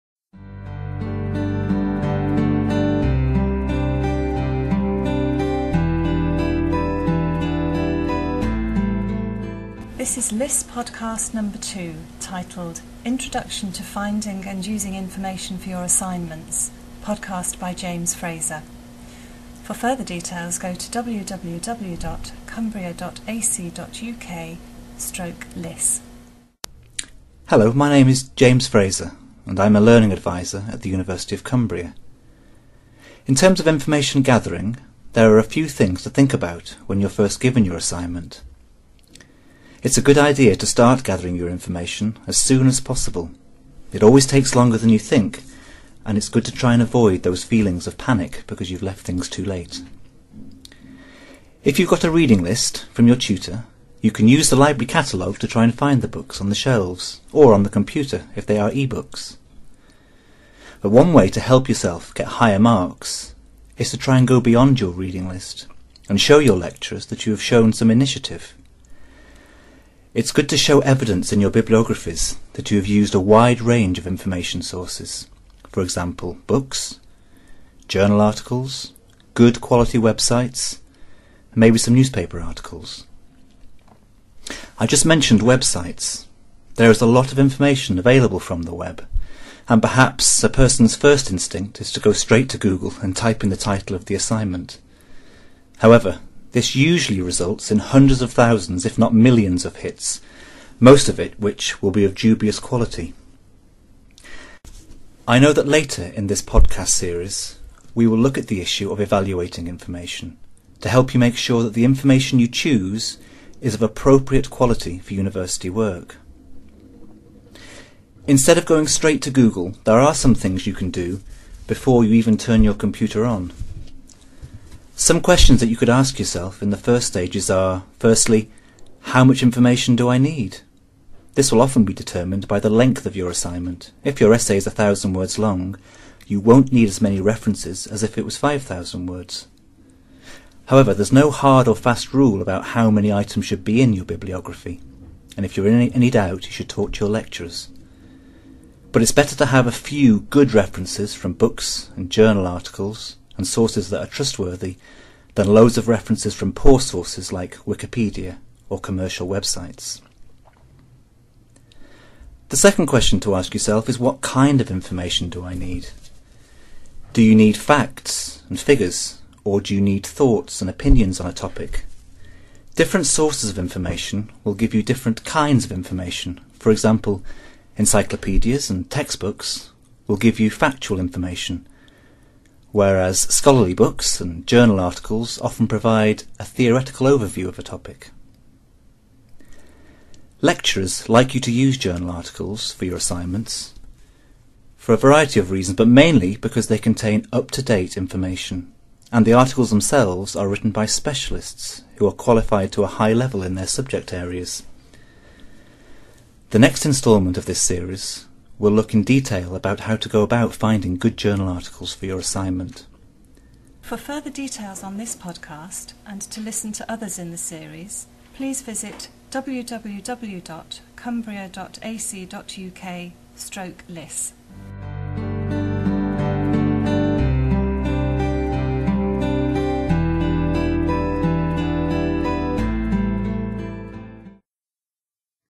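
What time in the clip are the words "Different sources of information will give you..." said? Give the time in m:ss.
2:52.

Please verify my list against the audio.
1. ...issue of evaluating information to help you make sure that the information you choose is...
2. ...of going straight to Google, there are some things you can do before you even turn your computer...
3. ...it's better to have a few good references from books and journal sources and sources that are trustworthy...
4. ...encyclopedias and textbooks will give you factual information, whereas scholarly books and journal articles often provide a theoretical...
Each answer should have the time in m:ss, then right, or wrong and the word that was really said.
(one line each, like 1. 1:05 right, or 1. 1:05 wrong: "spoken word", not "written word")
1. 1:48 right
2. 1:58 right
3. 2:29 wrong: "articles", not "sources"
4. 2:57 right.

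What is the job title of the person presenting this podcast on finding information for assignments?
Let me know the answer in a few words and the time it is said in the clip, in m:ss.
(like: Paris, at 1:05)
Learning advisor, at 0:29.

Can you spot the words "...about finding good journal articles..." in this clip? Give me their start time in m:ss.
3:30.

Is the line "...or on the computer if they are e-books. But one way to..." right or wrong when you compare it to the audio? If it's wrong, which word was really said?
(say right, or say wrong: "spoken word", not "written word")
right.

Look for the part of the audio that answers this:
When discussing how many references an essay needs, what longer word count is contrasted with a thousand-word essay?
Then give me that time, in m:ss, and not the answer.
2:18.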